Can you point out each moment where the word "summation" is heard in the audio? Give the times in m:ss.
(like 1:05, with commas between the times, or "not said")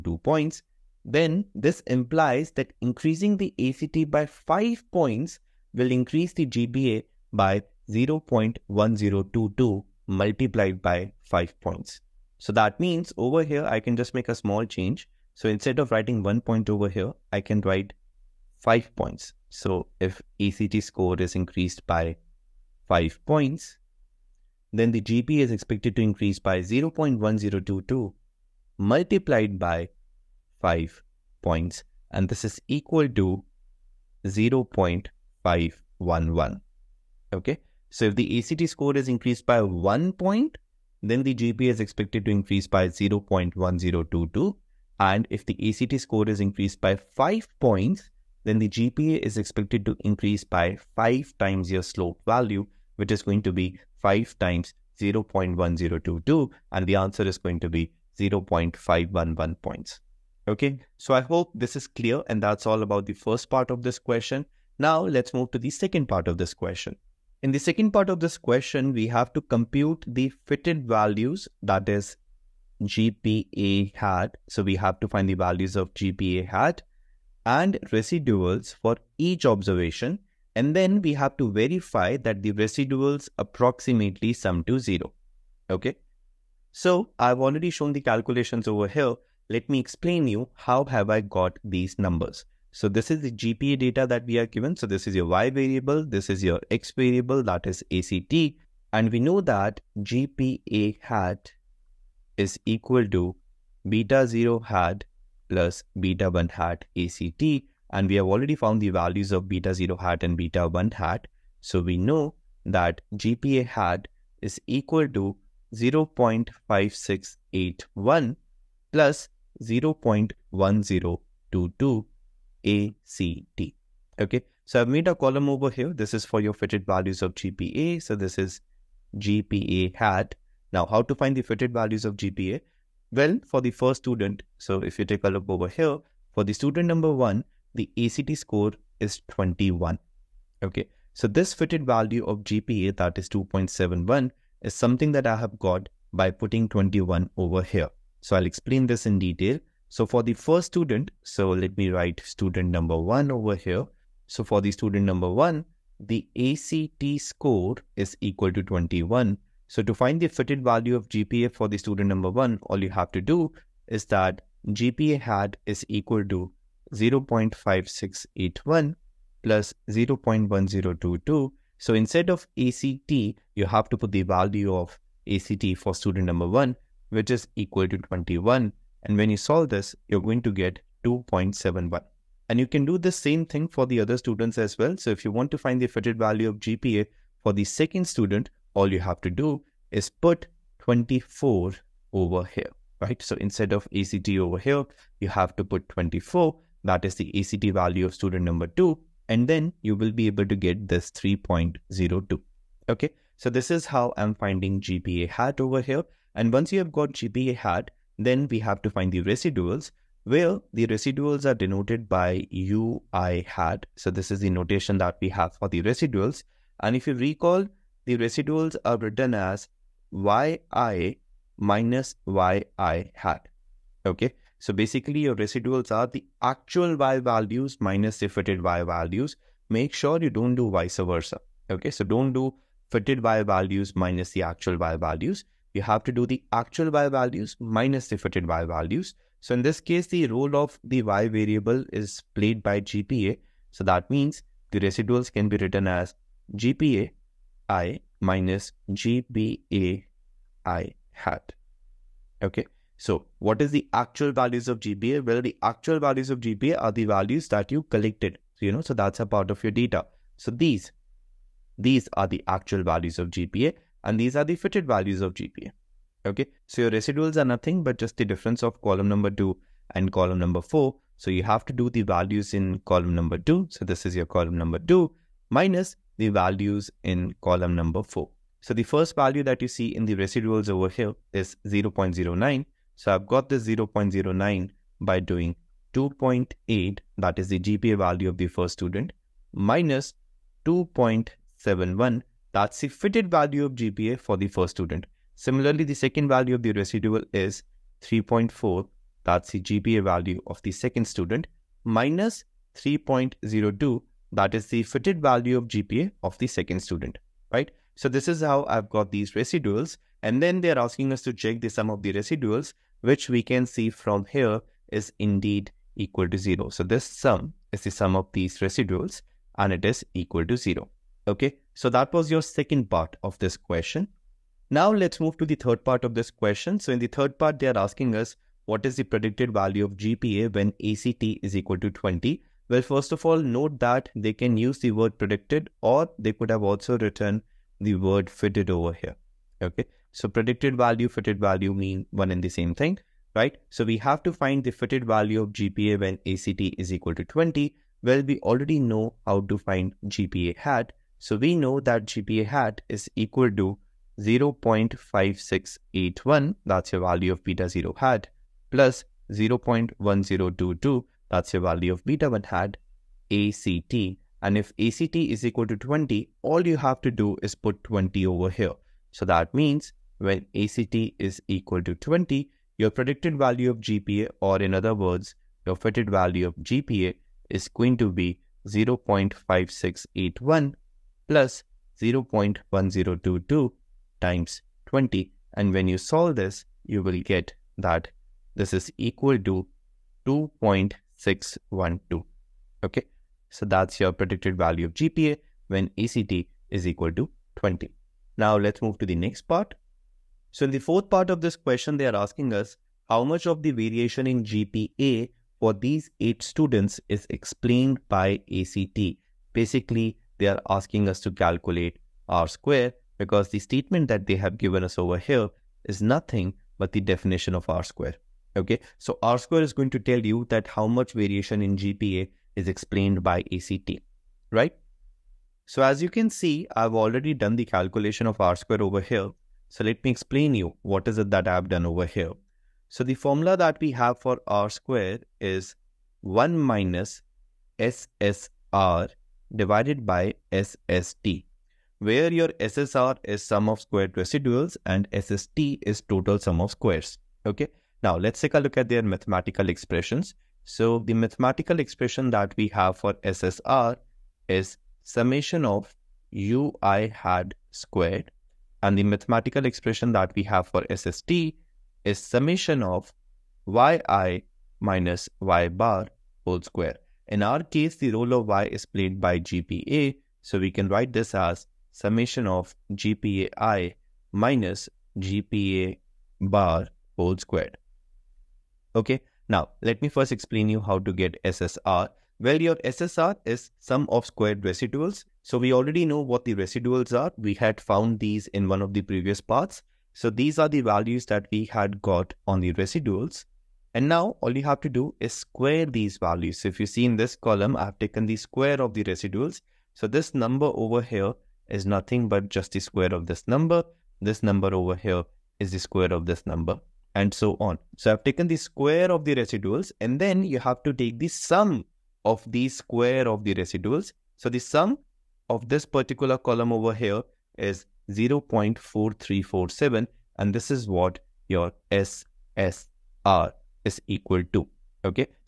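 7:35, 7:42, 7:51.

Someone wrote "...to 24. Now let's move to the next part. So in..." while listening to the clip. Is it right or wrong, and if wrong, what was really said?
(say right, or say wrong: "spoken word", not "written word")
wrong: "20", not "24".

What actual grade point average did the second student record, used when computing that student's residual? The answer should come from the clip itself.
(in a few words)
3.4.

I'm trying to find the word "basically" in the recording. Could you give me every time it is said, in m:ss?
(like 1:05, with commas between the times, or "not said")
3:44, 6:49.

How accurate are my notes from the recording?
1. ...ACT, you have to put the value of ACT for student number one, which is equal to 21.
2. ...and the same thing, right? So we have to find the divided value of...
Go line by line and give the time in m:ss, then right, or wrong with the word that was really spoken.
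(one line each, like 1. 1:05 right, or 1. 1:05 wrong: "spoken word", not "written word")
1. 2:52 right
2. 5:42 wrong: "fitted", not "divided".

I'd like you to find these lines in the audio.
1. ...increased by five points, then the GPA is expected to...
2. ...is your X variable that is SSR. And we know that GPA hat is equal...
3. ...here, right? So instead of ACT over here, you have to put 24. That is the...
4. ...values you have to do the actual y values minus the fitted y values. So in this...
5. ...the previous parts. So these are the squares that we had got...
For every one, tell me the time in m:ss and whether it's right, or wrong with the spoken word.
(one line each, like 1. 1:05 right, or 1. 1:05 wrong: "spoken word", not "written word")
1. 0:46 right
2. 1:36 wrong: "ACT", not "SSR"
3. 3:12 right
4. 3:54 right
5. 8:08 wrong: "values", not "squares".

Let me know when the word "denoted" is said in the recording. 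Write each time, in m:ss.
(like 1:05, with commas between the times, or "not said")
3:31.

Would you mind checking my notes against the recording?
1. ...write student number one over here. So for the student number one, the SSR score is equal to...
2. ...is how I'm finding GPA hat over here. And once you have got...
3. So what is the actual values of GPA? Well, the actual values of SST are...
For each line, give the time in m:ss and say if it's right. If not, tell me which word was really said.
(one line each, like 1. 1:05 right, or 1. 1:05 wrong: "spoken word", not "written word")
1. 2:31 wrong: "ACT", not "SSR"
2. 3:23 right
3. 4:12 wrong: "GPA", not "SST".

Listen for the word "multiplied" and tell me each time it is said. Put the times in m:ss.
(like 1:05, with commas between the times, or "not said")
0:10, 0:28.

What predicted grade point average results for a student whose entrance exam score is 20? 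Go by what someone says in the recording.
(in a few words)
2.612.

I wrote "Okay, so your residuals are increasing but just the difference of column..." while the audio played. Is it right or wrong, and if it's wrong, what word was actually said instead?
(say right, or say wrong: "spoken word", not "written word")
wrong: "nothing", not "increasing".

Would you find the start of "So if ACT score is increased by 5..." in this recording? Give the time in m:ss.
0:19.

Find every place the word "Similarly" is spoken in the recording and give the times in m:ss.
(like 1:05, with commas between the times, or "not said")
4:55.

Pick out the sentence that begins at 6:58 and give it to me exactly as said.
Okay, so r square is going to tell you that how much variation in GPA is explained by ACT, right?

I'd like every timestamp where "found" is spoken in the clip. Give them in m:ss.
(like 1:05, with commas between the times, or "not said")
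1:48, 8:07.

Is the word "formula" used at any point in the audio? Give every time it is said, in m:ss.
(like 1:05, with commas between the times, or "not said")
7:13.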